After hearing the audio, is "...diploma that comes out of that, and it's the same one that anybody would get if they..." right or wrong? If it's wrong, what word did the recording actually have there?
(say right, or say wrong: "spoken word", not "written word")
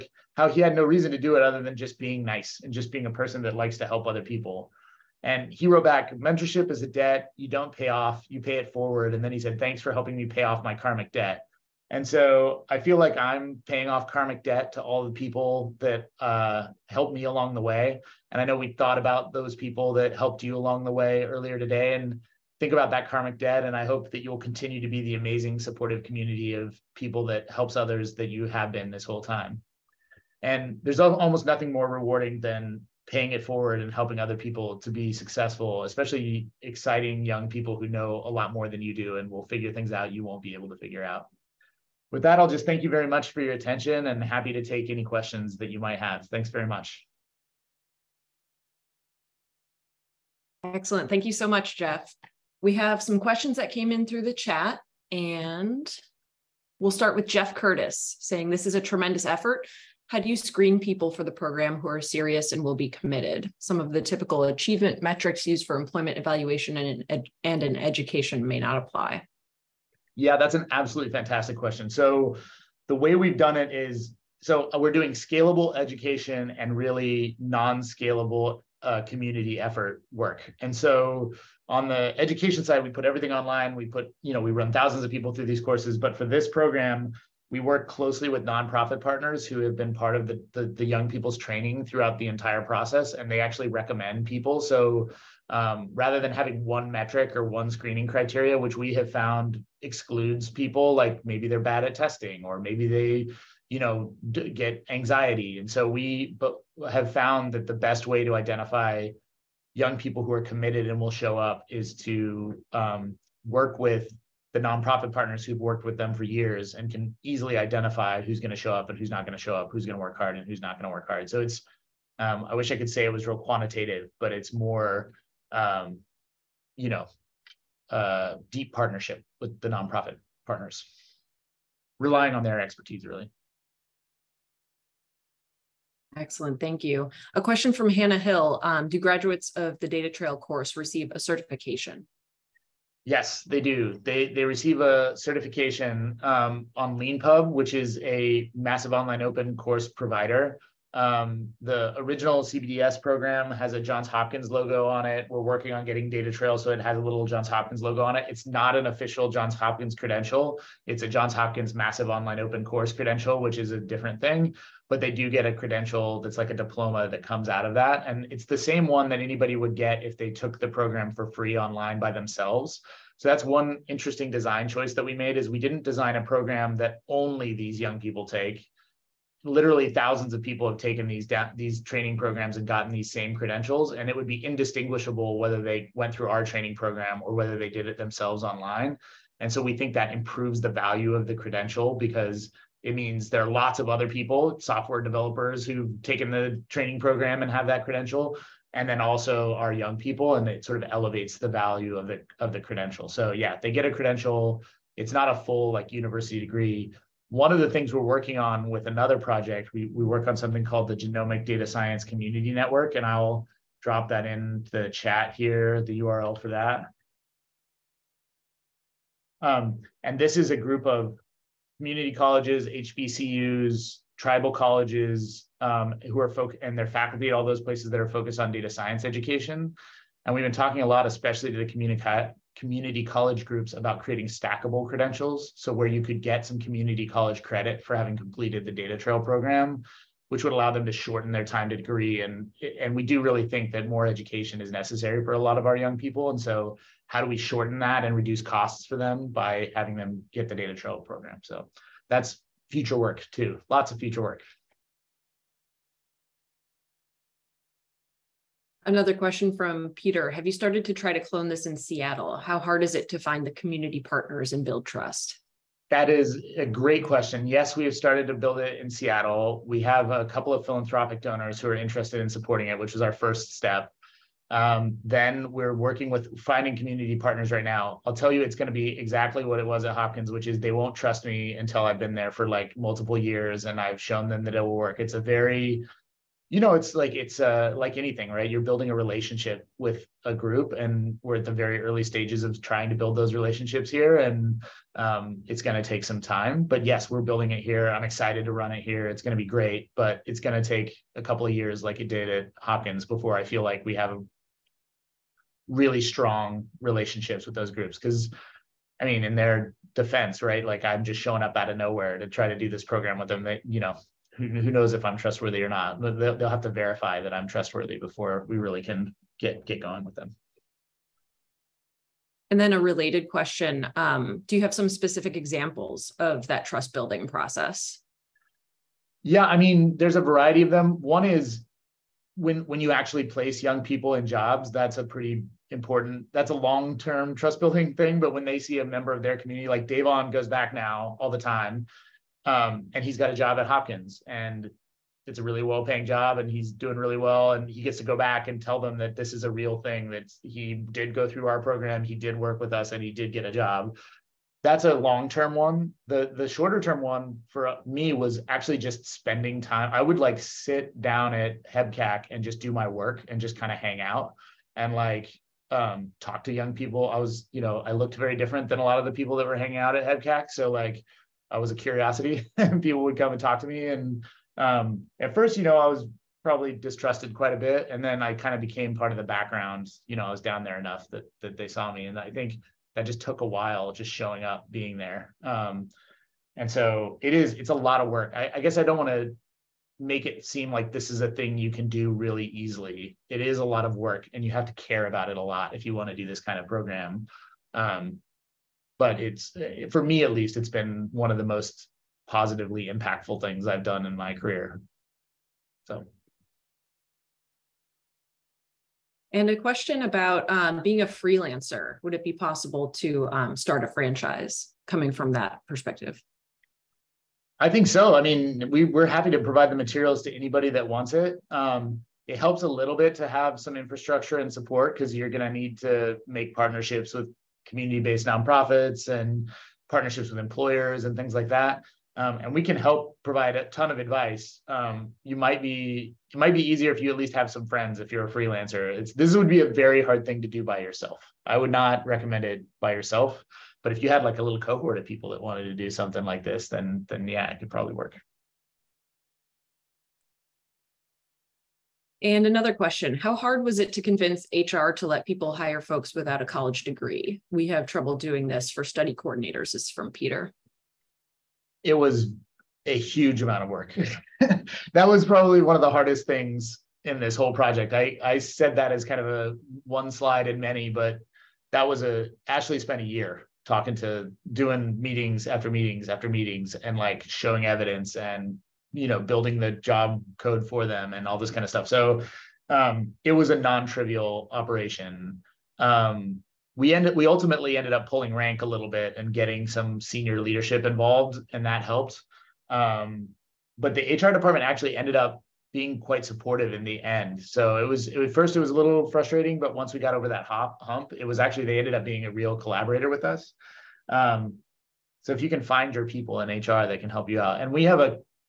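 right.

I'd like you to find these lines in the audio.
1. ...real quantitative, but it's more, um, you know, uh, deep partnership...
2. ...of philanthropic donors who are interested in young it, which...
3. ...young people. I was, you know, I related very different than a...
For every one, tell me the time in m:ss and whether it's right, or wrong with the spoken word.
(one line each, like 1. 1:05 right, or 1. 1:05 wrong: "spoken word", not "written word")
1. 2:03 right
2. 4:30 wrong: "supporting", not "young"
3. 6:06 wrong: "looked", not "related".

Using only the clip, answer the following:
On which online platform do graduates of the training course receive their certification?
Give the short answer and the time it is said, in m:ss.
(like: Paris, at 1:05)
LeanPub, at 2:26.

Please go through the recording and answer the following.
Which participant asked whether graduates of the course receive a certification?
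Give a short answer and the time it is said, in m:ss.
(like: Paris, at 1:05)
Hannah Hill, at 2:17.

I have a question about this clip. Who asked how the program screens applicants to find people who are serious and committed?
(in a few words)
Jeff Curtis.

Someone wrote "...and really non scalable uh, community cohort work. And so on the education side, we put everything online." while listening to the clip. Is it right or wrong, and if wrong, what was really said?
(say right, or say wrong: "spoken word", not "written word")
wrong: "effort", not "cohort".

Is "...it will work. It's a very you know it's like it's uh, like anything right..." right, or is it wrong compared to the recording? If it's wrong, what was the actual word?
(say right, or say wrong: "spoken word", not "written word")
right.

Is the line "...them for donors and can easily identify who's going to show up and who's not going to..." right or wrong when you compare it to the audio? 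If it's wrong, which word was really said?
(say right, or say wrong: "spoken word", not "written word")
wrong: "years", not "donors".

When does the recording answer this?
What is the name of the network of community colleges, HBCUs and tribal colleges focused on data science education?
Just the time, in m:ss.
3:30.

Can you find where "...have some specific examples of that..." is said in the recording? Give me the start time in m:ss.
5:24.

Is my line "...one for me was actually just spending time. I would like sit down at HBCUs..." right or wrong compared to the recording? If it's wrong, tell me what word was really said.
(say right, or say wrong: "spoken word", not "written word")
wrong: "HEBCAC", not "HBCUs".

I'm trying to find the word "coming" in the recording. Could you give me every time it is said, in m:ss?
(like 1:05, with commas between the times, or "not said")
6:54.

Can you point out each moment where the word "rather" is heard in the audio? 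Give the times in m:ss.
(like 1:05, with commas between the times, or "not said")
1:35.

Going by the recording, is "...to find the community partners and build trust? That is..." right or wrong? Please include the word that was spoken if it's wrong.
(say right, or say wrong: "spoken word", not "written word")
right.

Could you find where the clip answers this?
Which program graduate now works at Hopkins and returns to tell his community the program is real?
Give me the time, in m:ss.
5:39.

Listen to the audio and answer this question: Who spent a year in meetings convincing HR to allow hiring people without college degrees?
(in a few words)
Ashley.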